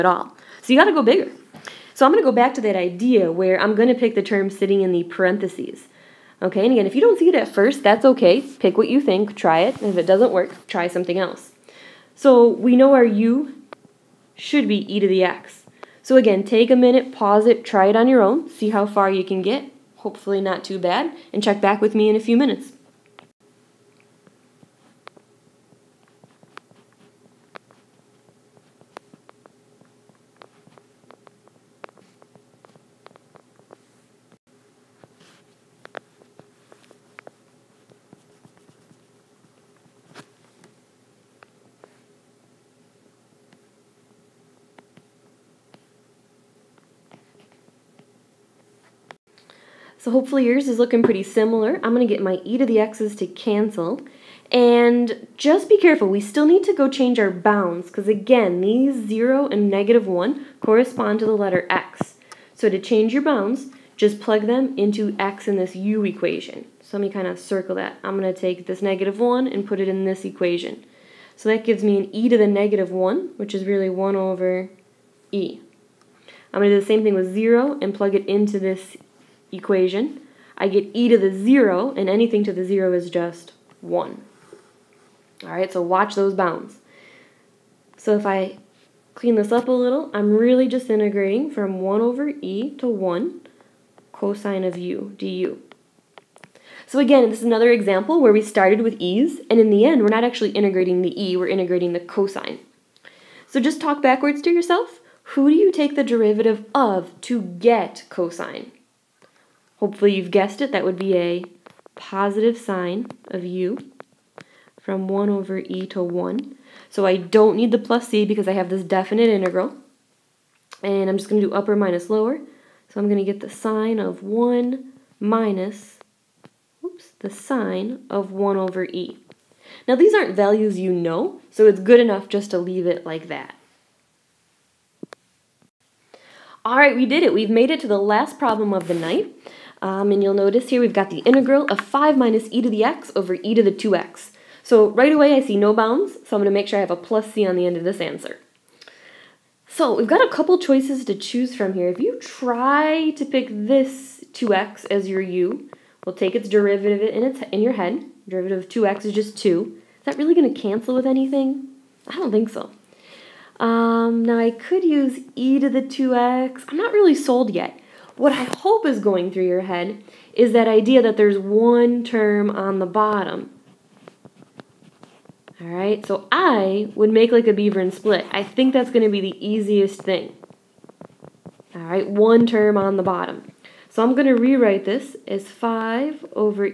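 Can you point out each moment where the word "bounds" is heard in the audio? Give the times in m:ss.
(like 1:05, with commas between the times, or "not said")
0:57, 1:03, 1:26, 2:25.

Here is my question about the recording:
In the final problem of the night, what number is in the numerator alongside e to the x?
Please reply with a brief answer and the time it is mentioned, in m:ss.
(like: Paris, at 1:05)
5, at 2:21.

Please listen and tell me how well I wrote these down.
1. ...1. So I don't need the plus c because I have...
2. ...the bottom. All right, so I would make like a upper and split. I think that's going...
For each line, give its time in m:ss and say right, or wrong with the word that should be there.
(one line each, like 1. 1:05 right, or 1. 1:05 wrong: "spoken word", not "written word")
1. 1:56 right
2. 2:52 wrong: "beaver", not "upper".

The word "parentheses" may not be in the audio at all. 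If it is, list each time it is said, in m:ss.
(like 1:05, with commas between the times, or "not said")
0:05.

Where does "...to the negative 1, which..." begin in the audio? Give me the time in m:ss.
1:12.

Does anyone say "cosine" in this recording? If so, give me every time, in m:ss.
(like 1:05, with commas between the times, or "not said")
1:34, 1:41, 1:48.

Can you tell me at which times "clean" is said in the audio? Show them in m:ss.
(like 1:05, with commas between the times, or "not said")
1:29.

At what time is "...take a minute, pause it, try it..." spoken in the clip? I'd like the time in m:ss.
0:16.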